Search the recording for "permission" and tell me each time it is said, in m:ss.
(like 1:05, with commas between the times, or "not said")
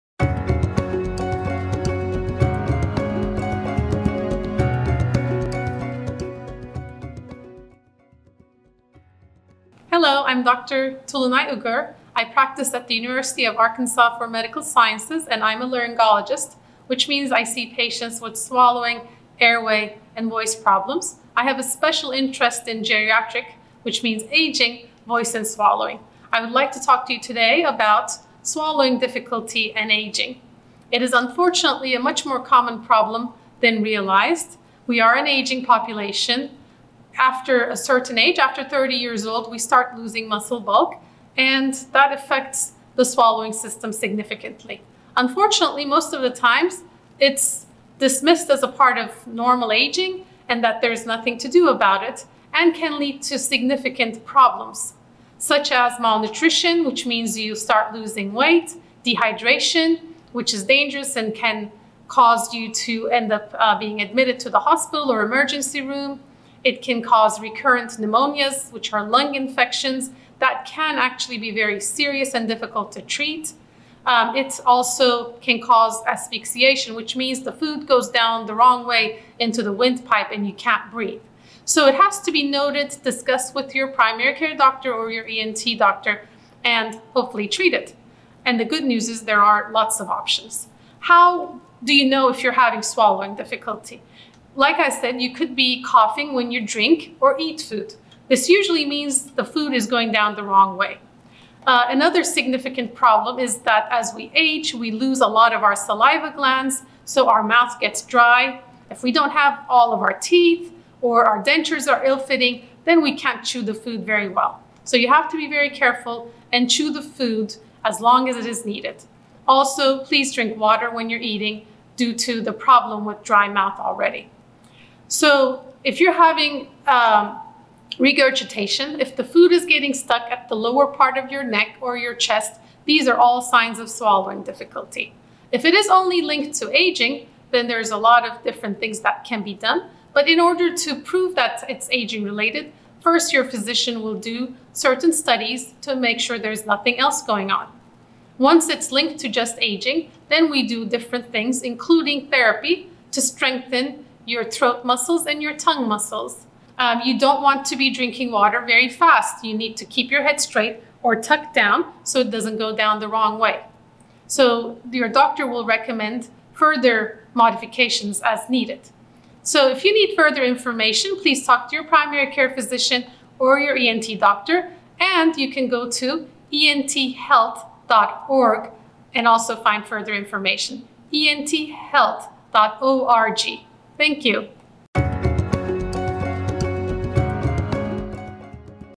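not said.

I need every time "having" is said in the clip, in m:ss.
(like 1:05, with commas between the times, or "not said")
1:32, 2:06.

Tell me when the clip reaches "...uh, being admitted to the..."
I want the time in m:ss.
1:03.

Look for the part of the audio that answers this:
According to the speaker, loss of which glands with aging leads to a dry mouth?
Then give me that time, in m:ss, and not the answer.
1:45.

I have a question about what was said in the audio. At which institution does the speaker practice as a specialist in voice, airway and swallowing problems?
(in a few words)
University of Arkansas for Medical Sciences.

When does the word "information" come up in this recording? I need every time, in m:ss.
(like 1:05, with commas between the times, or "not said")
2:50, 3:00.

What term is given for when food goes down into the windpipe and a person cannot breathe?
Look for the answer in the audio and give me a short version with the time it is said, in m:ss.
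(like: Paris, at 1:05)
asphyxiation, at 1:16.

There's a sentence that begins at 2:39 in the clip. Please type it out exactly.
You need to keep your head straight or tucked down so it doesn't go down the wrong way.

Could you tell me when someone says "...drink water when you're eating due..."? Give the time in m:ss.
2:00.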